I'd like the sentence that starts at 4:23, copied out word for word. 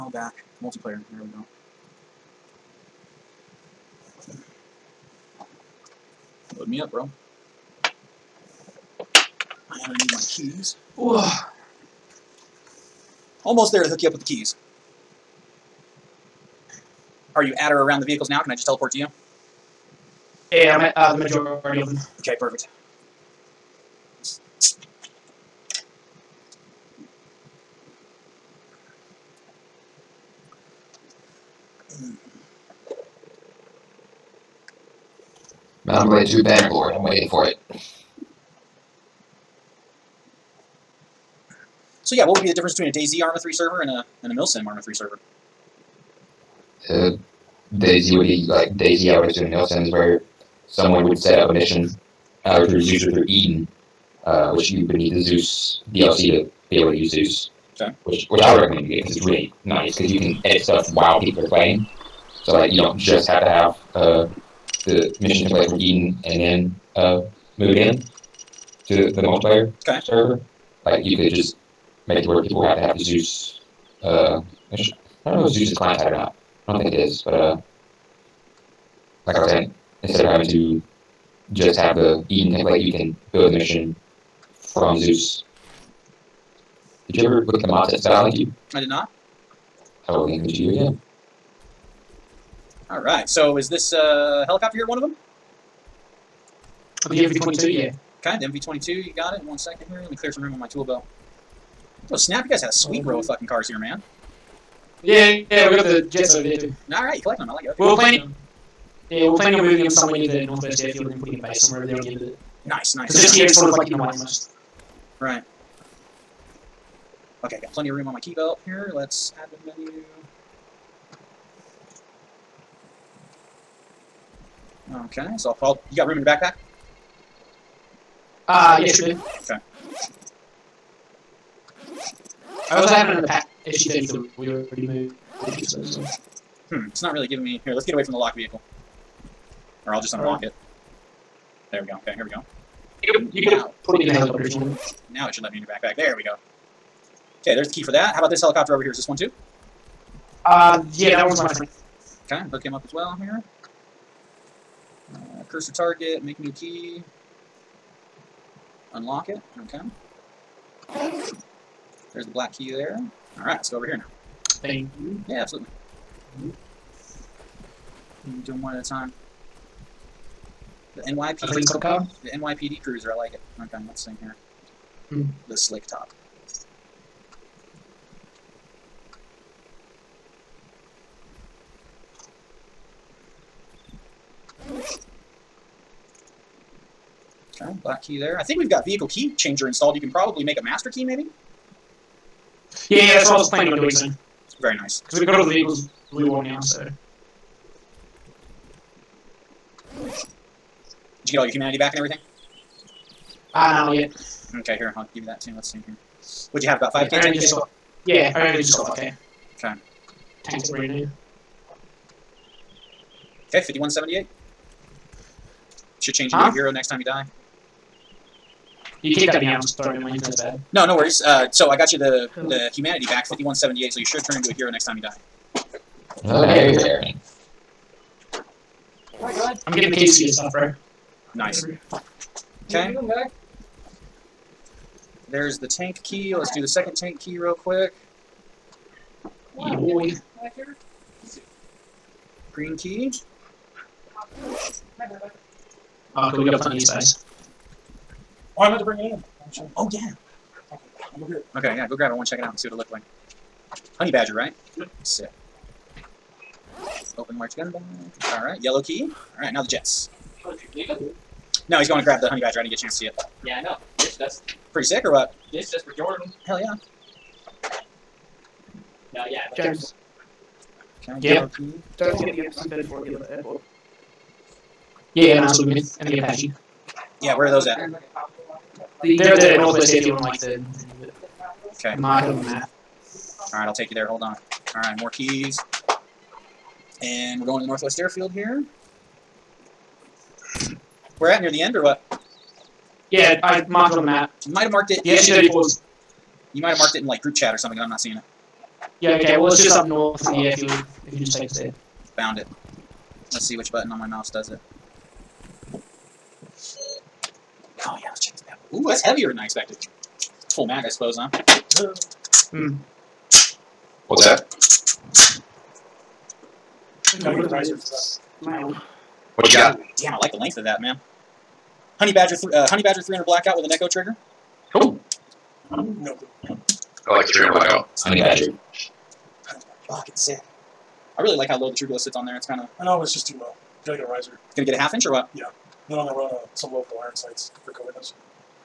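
This does Pretty sick or what?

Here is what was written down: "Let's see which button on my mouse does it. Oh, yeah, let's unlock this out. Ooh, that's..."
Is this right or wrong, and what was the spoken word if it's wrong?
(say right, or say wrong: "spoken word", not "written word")
wrong: "check", not "unlock".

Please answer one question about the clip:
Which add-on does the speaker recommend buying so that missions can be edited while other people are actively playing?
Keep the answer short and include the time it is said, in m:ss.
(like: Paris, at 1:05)
Zeus DLC, at 0:55.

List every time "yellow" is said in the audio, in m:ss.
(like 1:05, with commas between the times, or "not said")
4:18, 4:31.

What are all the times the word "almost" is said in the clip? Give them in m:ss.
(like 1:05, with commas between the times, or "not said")
0:13, 1:54.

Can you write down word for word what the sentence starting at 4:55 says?
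The SU-34 You might have marked it in like group chat or something, and I'm not seeing it.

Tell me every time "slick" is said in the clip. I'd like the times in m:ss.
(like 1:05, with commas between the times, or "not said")
2:55.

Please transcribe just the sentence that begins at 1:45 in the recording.
Yeah, yeah, we got the jets over here too.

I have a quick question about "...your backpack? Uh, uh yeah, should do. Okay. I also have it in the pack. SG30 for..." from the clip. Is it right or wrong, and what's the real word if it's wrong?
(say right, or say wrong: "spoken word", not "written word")
right.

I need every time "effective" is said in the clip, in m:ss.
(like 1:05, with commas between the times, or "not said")
not said.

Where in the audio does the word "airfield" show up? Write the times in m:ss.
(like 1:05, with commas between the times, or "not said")
1:50, 4:39, 4:47.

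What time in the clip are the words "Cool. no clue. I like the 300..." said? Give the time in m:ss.
5:24.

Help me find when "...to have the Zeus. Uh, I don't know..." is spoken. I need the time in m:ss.
1:12.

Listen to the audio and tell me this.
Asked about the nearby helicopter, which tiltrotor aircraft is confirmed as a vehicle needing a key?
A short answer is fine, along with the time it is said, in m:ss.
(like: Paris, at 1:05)
MV-22, at 1:37.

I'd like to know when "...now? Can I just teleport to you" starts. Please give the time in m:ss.
0:18.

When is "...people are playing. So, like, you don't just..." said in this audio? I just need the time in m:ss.
1:01.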